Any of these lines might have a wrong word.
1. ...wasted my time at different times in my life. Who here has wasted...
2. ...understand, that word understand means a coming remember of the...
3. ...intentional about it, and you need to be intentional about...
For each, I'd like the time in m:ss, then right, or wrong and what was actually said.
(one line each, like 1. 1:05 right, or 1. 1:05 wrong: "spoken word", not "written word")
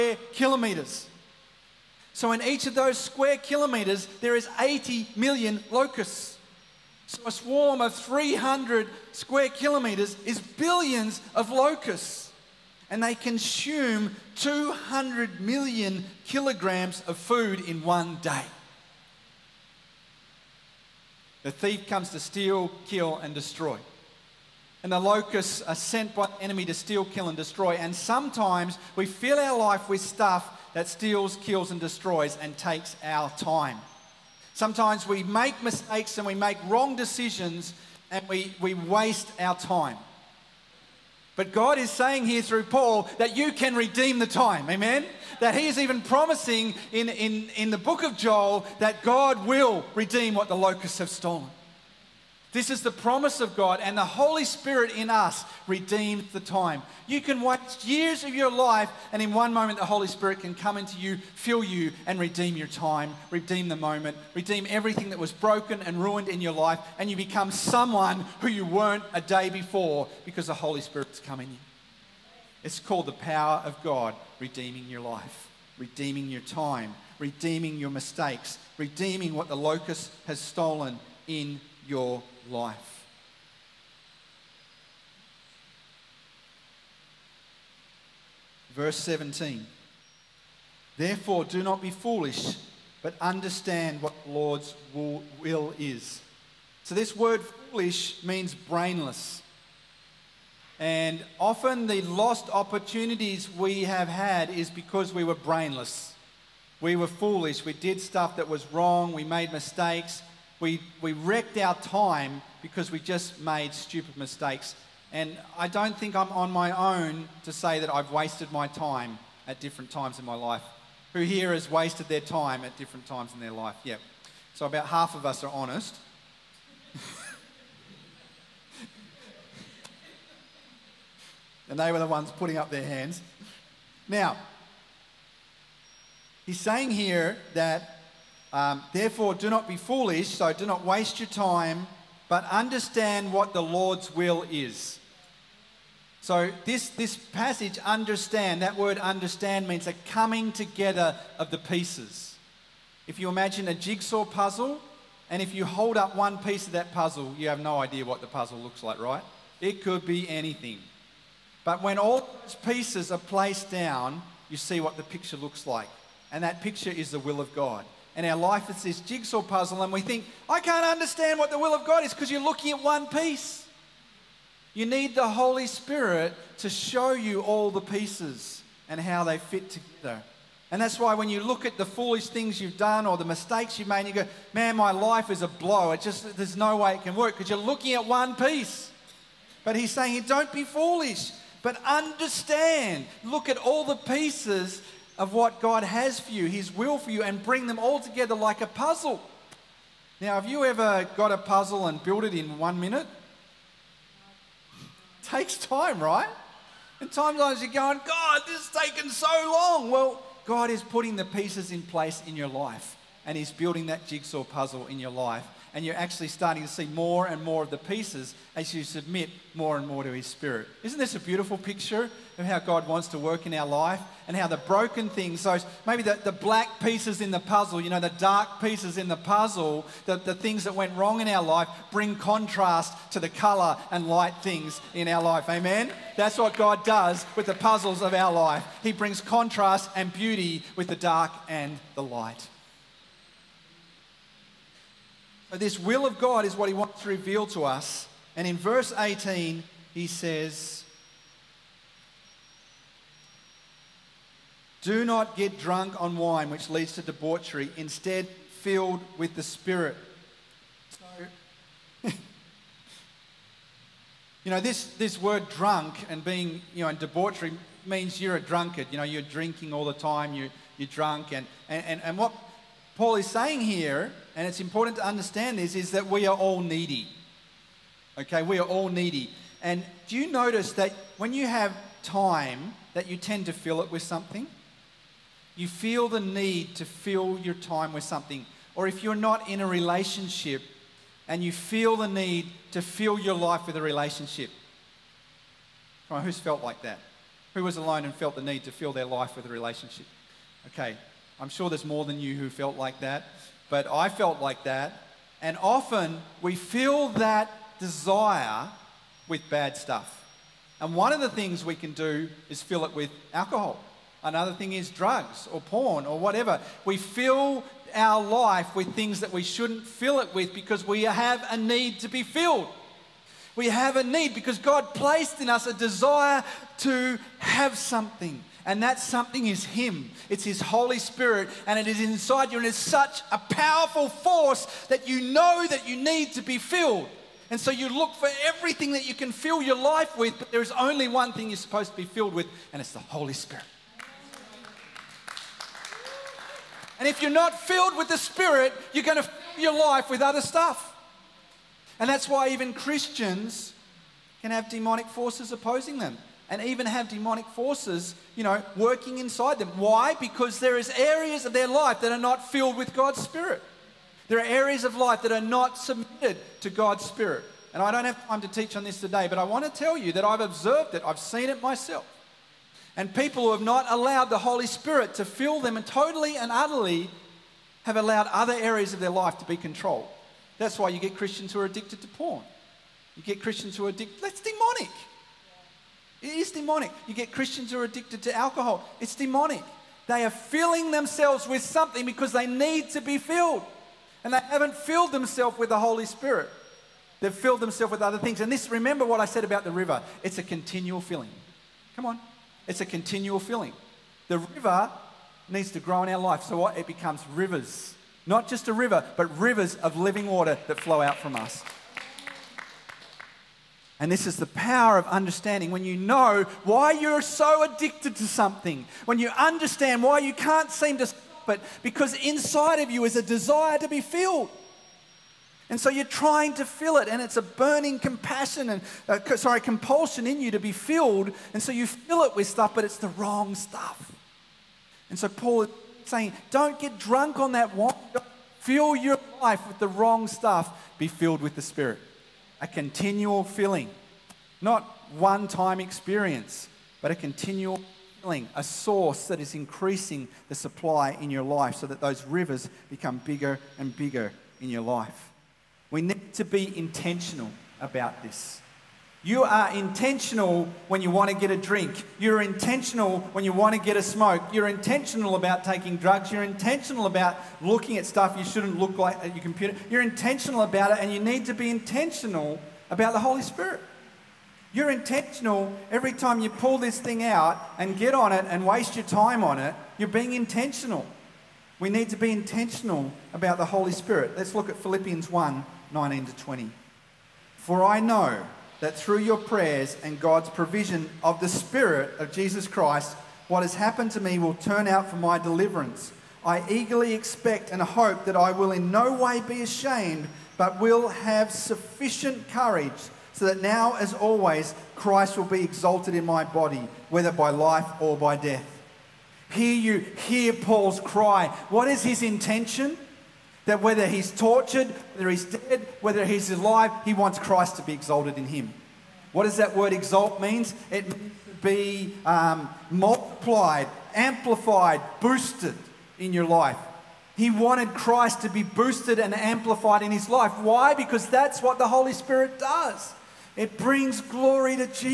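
1. 1:58 right
2. 2:27 wrong: "together", not "remember"
3. 7:50 right.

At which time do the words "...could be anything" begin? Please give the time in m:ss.
2:39.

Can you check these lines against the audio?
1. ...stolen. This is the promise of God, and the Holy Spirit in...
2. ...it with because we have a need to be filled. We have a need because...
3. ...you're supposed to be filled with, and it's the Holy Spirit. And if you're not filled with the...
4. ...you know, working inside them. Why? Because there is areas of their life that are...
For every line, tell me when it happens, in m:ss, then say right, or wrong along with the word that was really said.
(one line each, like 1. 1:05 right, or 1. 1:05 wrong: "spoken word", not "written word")
1. 0:51 right
2. 5:20 right
3. 5:41 right
4. 5:58 right.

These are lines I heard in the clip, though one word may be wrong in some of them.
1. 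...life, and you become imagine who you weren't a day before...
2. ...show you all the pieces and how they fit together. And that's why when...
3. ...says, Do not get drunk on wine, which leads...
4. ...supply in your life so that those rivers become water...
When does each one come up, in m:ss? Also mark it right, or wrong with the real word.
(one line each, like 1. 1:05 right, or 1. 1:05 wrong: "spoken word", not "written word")
1. 1:06 wrong: "someone", not "imagine"
2. 2:56 right
3. 4:10 right
4. 7:30 wrong: "bigger", not "water".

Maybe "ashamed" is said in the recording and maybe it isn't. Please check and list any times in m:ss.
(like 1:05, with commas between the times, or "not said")
8:19.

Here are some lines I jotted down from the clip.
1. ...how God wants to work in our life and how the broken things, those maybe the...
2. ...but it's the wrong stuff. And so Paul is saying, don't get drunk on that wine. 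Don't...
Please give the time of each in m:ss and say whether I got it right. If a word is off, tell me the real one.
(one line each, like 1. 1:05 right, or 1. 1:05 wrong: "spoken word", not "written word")
1. 3:42 right
2. 7:12 right.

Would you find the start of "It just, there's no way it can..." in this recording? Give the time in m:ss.
3:05.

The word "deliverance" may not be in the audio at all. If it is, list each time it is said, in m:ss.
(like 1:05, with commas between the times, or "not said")
8:15.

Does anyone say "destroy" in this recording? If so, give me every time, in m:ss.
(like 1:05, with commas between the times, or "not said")
0:23, 0:27, 0:31.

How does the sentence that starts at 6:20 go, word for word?
That's why you get Christians who are addicted to porn.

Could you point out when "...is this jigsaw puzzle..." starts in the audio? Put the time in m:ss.
2:48.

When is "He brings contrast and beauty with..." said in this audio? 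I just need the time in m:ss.
3:58.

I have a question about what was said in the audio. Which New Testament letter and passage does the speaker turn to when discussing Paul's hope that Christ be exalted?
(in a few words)
Philippians 1:19-20.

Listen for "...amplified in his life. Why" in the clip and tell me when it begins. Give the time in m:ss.
8:49.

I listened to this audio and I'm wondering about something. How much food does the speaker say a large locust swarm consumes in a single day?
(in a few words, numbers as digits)
200 million kilograms.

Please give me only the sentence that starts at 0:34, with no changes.
Sometimes we make mistakes and we make wrong decisions and we, we waste our time.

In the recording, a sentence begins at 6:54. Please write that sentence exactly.
And this is the power of understanding.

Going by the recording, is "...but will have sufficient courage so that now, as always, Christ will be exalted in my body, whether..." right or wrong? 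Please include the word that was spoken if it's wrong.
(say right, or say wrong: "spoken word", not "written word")
right.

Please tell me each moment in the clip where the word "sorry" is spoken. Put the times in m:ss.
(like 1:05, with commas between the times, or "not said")
7:09.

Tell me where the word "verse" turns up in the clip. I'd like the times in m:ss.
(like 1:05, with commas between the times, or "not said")
1:28, 4:08.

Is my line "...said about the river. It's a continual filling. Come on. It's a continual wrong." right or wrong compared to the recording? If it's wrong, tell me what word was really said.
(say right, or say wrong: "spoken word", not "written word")
wrong: "filling", not "wrong".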